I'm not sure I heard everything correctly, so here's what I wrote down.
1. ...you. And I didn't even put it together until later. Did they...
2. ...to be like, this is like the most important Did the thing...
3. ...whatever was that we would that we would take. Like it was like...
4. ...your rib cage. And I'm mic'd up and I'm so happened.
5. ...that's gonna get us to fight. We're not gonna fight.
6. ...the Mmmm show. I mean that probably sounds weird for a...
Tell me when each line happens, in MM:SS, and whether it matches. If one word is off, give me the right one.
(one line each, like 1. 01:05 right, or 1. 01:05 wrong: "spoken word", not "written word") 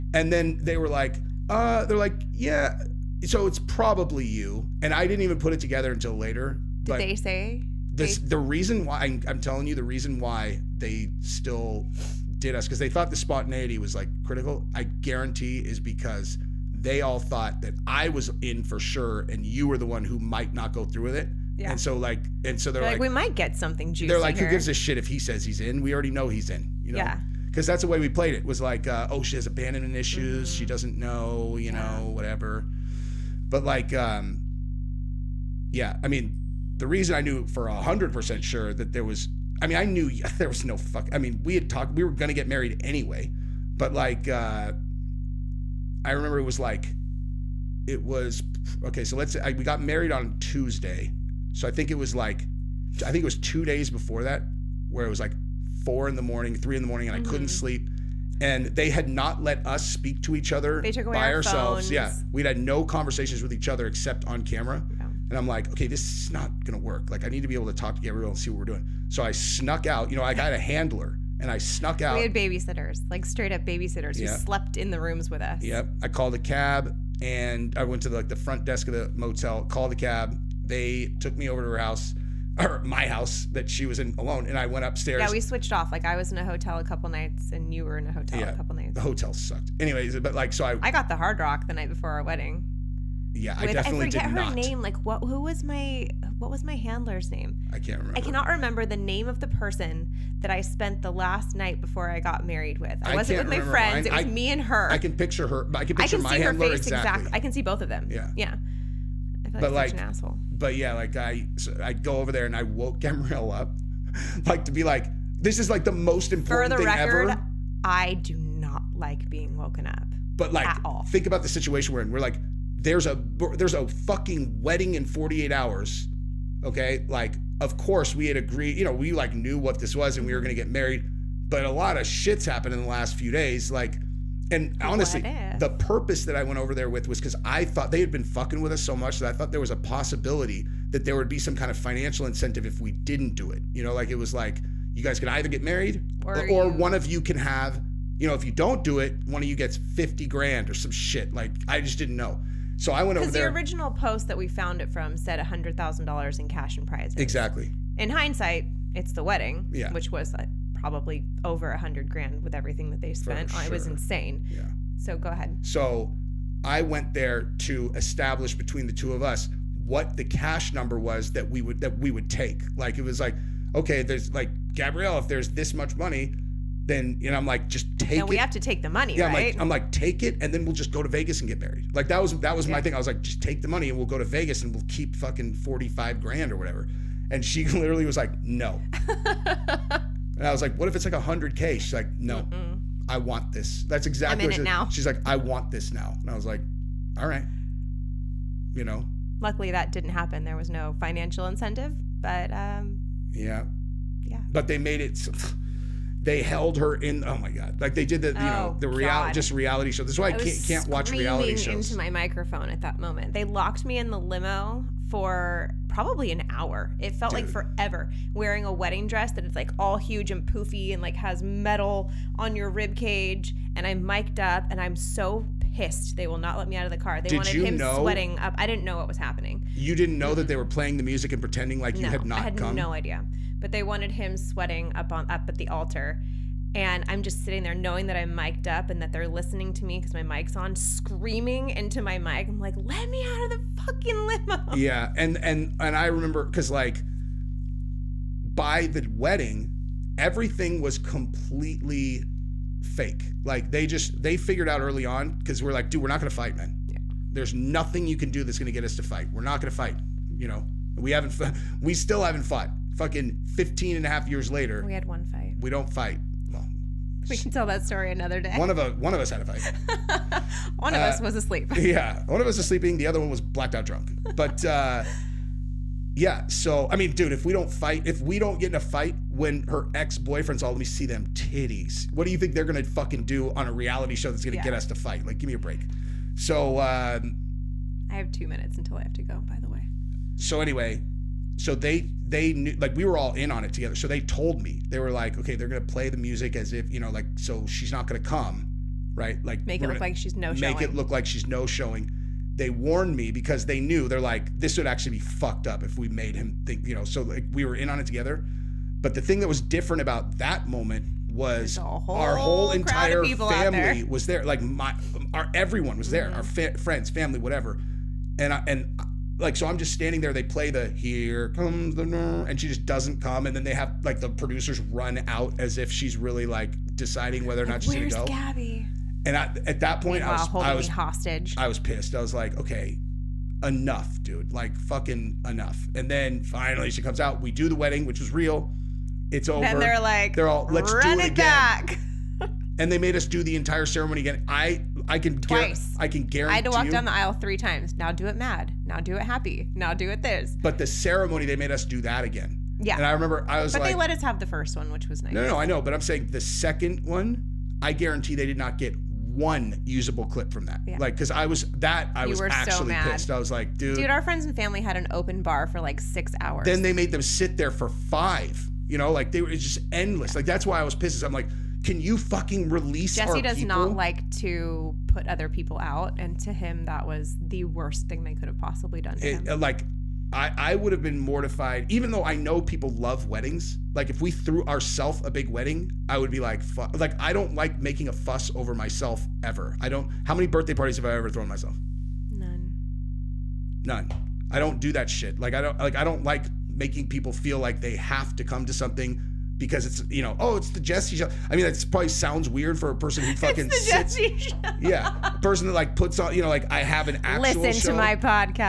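1. 00:04 right
2. 01:54 wrong: "For", not "Did"
3. 02:50 wrong: "number", not "whatever"
4. 03:42 wrong: "pissed", not "happened"
5. 04:18 right
6. 06:40 wrong: "Jesse", not "Mmmm".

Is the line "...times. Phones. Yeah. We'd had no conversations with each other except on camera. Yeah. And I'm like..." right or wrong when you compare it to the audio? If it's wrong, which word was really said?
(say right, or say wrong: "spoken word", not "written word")
wrong: "ourselves", not "times".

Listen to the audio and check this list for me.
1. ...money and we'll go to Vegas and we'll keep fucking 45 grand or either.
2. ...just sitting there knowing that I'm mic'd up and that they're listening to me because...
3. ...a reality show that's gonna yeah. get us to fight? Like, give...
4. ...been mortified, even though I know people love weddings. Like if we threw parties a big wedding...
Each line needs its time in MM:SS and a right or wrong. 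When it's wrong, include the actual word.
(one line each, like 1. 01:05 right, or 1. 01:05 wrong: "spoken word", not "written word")
1. 03:03 wrong: "whatever", not "either"
2. 03:57 right
3. 04:43 right
4. 06:21 wrong: "ourselves", not "parties".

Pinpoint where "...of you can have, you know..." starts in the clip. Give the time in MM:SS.
02:26.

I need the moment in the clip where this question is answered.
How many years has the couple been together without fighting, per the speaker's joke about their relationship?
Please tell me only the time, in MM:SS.
04:23.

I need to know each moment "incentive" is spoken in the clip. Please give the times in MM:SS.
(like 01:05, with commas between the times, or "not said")
02:22, 03:21.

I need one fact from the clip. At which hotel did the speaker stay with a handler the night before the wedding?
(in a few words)
Hard Rock.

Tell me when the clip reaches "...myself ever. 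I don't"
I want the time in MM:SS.
06:28.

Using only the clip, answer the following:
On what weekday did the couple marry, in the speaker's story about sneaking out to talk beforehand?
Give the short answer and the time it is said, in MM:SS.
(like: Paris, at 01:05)
Tuesday, at 00:50.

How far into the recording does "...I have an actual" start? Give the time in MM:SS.
06:46.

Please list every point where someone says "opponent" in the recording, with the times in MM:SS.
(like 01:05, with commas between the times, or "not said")
not said.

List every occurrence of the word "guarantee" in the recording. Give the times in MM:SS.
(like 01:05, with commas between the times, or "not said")
00:15, 05:46, 05:57.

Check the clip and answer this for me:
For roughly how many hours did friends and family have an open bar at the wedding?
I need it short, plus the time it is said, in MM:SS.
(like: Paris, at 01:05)
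6, at 06:05.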